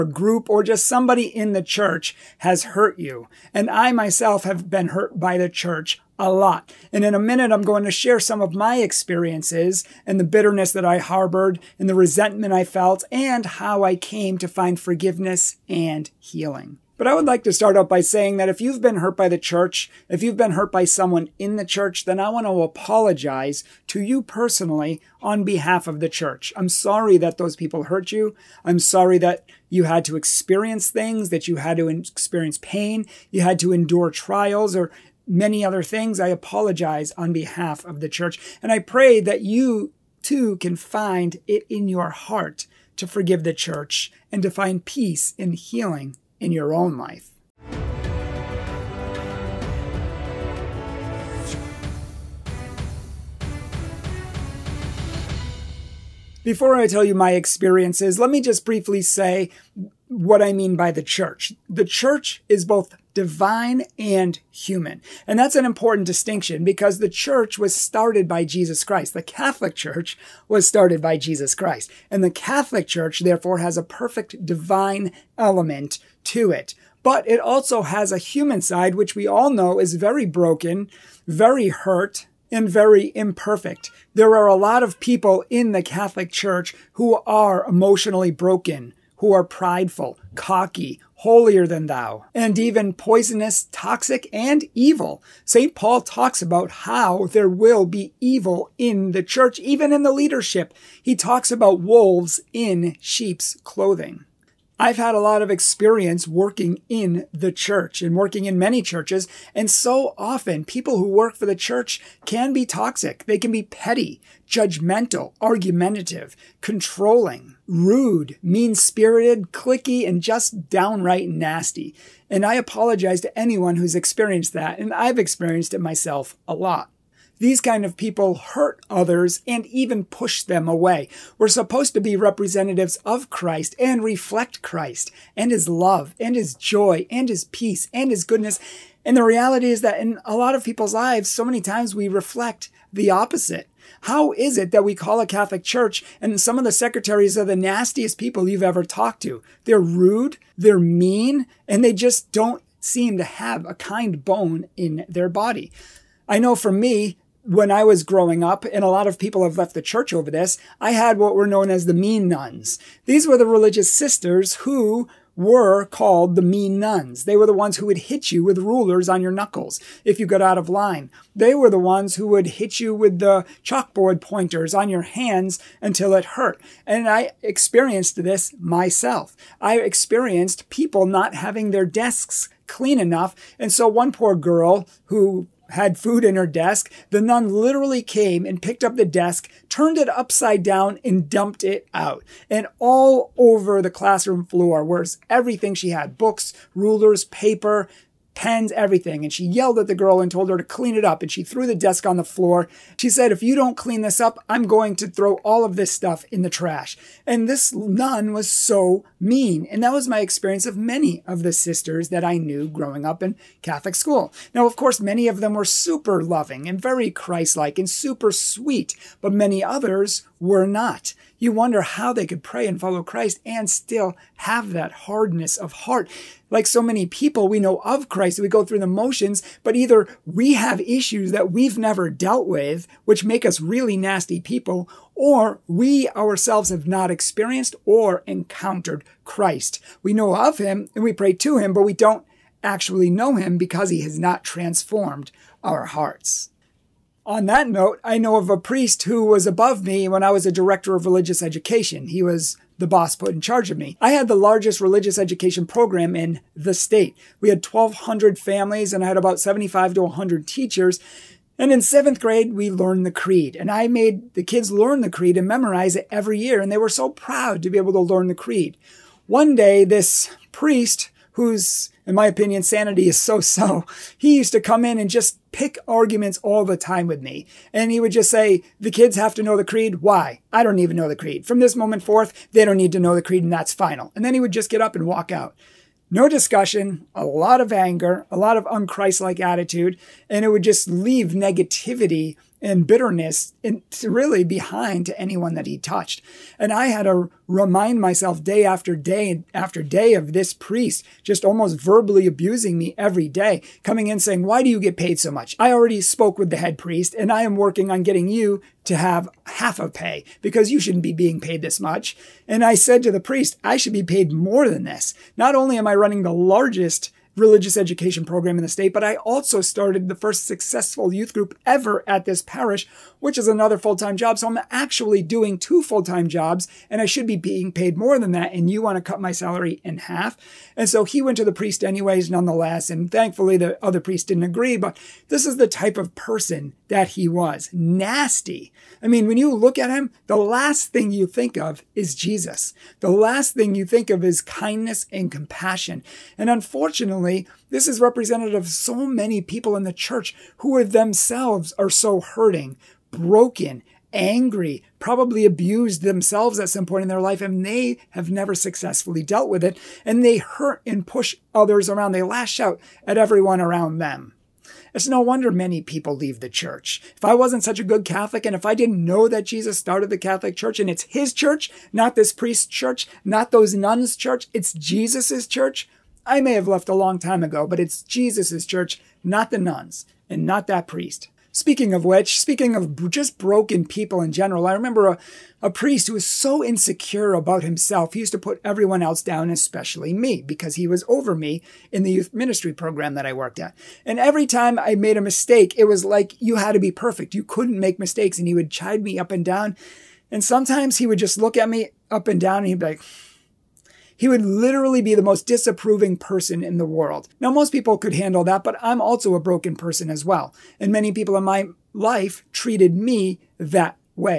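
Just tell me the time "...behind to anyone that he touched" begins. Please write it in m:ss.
4:54.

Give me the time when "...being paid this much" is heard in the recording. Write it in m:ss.
5:11.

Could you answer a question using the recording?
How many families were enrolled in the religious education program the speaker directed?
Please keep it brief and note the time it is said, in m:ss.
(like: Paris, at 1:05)
1,200, at 4:17.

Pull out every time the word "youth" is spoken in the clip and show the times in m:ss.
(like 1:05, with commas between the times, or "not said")
5:21, 6:32.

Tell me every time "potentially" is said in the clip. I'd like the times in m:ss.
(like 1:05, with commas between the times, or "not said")
not said.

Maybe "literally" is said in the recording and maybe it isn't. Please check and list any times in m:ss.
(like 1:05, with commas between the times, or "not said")
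3:07, 6:44.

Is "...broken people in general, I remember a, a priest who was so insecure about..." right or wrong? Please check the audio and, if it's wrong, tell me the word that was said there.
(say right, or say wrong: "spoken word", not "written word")
right.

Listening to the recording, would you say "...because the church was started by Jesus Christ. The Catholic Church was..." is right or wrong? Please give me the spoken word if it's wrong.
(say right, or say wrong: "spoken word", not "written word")
right.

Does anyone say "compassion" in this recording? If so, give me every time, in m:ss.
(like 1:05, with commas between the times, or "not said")
5:45.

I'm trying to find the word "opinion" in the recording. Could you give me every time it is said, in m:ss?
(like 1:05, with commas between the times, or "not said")
4:32.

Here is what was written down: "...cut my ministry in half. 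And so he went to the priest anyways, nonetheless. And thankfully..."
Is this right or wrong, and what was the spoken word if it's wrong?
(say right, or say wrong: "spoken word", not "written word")
wrong: "salary", not "ministry".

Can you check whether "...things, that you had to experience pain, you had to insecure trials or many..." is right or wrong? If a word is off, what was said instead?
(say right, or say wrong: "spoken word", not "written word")
wrong: "endure", not "insecure".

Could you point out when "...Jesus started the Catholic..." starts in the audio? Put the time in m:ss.
6:09.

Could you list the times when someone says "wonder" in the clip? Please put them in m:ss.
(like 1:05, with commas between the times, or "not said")
3:41, 6:05.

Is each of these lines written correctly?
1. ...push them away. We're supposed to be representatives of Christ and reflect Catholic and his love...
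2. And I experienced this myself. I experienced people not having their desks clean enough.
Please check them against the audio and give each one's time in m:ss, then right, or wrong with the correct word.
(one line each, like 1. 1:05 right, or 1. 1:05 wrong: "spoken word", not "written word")
1. 2:10 wrong: "Christ", not "Catholic"
2. 2:56 right.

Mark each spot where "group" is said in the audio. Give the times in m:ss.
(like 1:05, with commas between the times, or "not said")
0:00, 5:21.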